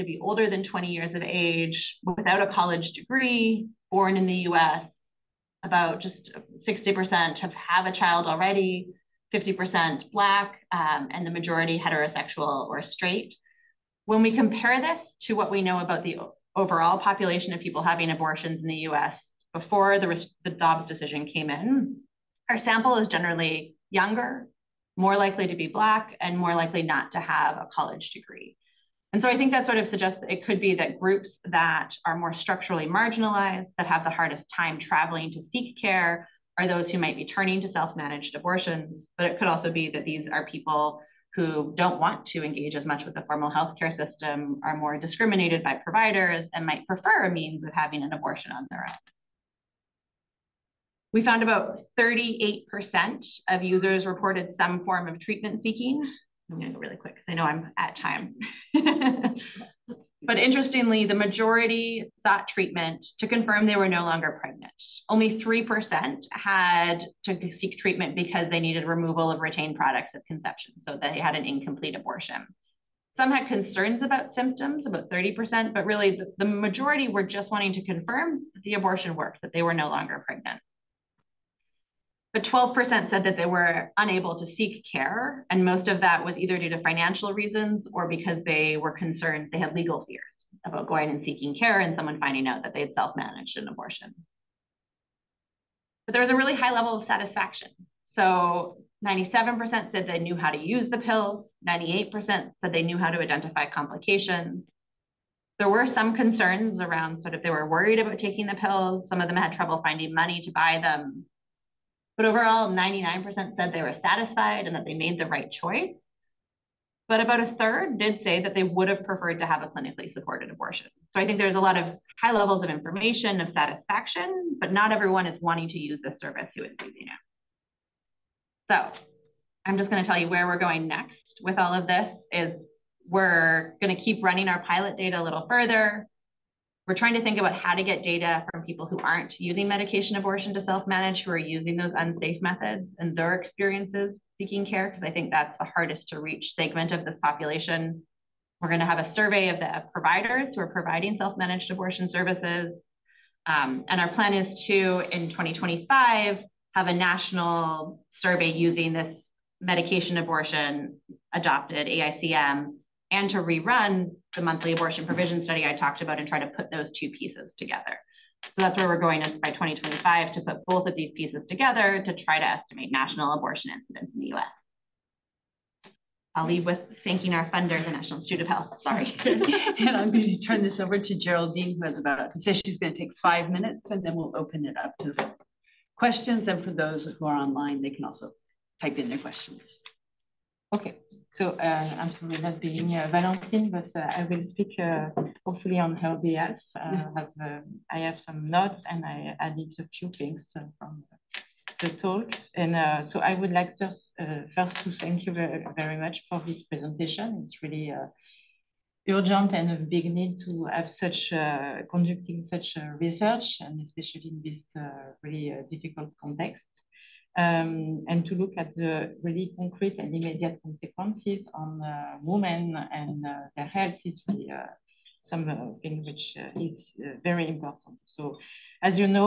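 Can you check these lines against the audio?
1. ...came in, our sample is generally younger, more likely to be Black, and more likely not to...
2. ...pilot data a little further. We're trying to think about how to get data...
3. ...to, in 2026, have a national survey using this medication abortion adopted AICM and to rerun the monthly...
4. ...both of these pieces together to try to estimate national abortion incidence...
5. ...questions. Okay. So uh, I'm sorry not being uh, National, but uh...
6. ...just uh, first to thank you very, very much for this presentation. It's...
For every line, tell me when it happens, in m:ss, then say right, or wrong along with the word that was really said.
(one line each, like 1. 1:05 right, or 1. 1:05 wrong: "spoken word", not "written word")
1. 0:21 right
2. 2:14 right
3. 2:34 wrong: "2025", not "2026"
4. 2:50 right
5. 3:09 wrong: "Valentine", not "National"
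6. 3:23 right.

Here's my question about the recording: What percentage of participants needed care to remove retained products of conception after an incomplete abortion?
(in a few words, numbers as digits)
3%.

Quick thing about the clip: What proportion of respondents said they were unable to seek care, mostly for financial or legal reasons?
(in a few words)
12%.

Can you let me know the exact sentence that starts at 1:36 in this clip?
But there was a really high level of satisfaction.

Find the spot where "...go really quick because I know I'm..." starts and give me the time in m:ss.
0:56.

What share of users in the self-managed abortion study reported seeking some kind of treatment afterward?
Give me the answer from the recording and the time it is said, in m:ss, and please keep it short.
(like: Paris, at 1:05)
38%, at 0:51.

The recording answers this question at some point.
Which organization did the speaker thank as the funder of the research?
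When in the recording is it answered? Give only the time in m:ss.
2:57.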